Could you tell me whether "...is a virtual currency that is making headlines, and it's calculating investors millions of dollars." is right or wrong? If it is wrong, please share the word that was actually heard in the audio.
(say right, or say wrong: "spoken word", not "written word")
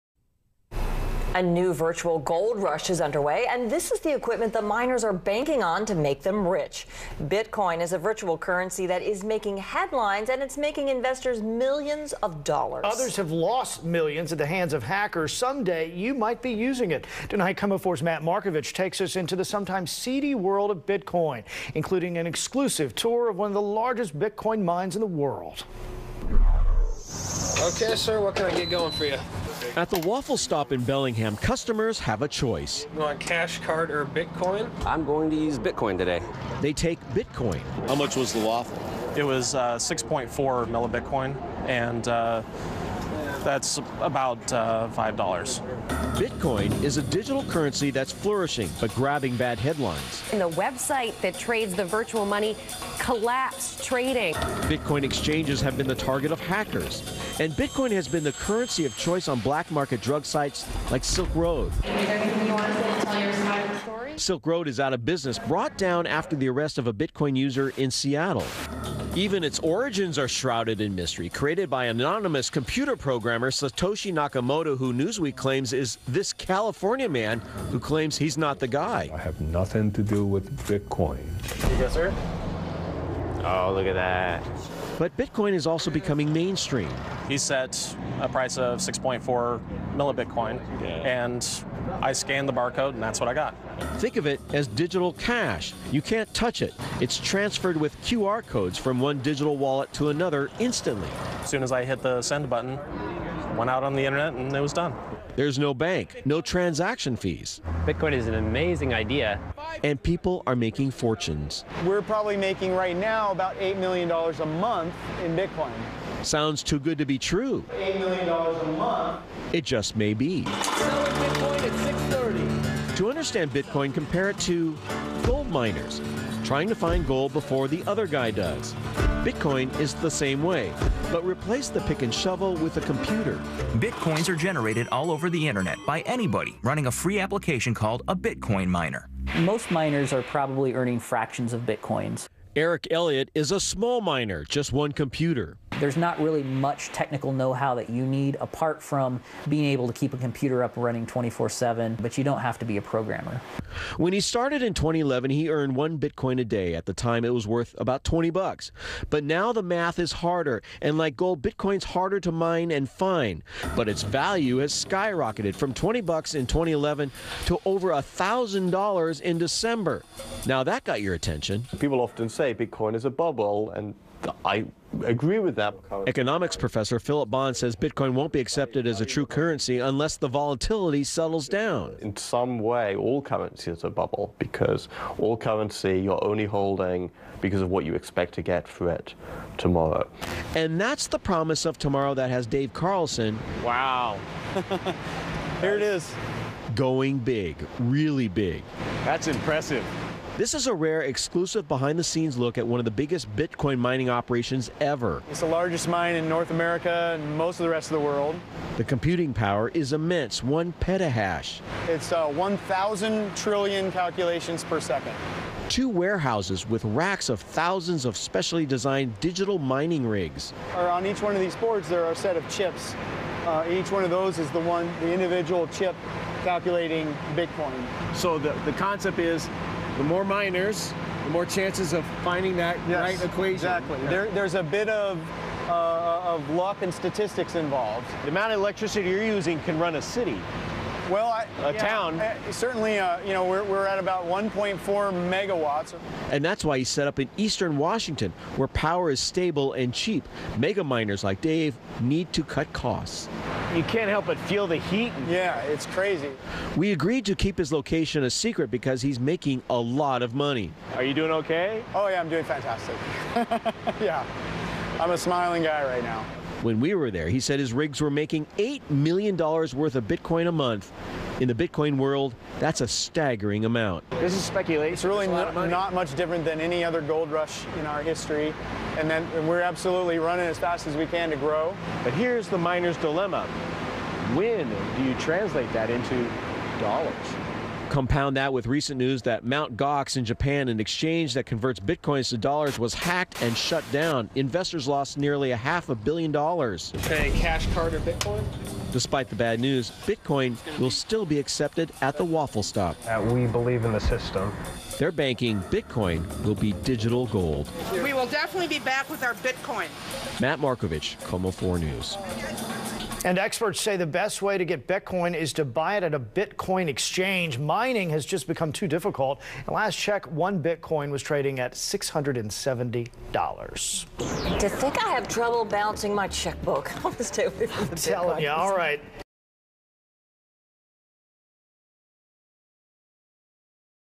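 wrong: "making", not "calculating".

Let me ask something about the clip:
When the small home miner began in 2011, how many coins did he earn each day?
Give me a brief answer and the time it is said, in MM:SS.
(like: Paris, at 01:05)
1 Bitcoin, at 02:35.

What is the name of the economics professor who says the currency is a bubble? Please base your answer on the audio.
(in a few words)
Philip Bond.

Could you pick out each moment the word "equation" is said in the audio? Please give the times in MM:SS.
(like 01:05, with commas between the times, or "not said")
03:53.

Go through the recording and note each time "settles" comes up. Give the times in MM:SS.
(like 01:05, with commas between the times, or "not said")
03:01.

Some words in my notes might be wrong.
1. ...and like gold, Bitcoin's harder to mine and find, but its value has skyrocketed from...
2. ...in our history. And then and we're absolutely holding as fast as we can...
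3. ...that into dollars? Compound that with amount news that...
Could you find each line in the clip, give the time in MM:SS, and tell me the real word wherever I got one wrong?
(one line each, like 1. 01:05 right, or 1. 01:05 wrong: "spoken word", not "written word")
1. 02:40 right
2. 04:37 wrong: "running", not "holding"
3. 04:45 wrong: "recent", not "amount".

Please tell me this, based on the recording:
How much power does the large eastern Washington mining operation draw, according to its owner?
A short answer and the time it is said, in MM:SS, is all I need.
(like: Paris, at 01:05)
1.4 megawatts, at 04:04.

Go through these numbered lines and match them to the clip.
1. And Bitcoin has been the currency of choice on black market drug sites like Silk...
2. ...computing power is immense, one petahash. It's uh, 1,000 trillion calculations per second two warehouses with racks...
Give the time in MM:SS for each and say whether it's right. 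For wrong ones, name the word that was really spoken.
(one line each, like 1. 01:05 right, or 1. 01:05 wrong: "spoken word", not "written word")
1. 00:57 right
2. 03:28 right.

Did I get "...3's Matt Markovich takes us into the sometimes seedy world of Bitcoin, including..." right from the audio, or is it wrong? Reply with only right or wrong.
wrong.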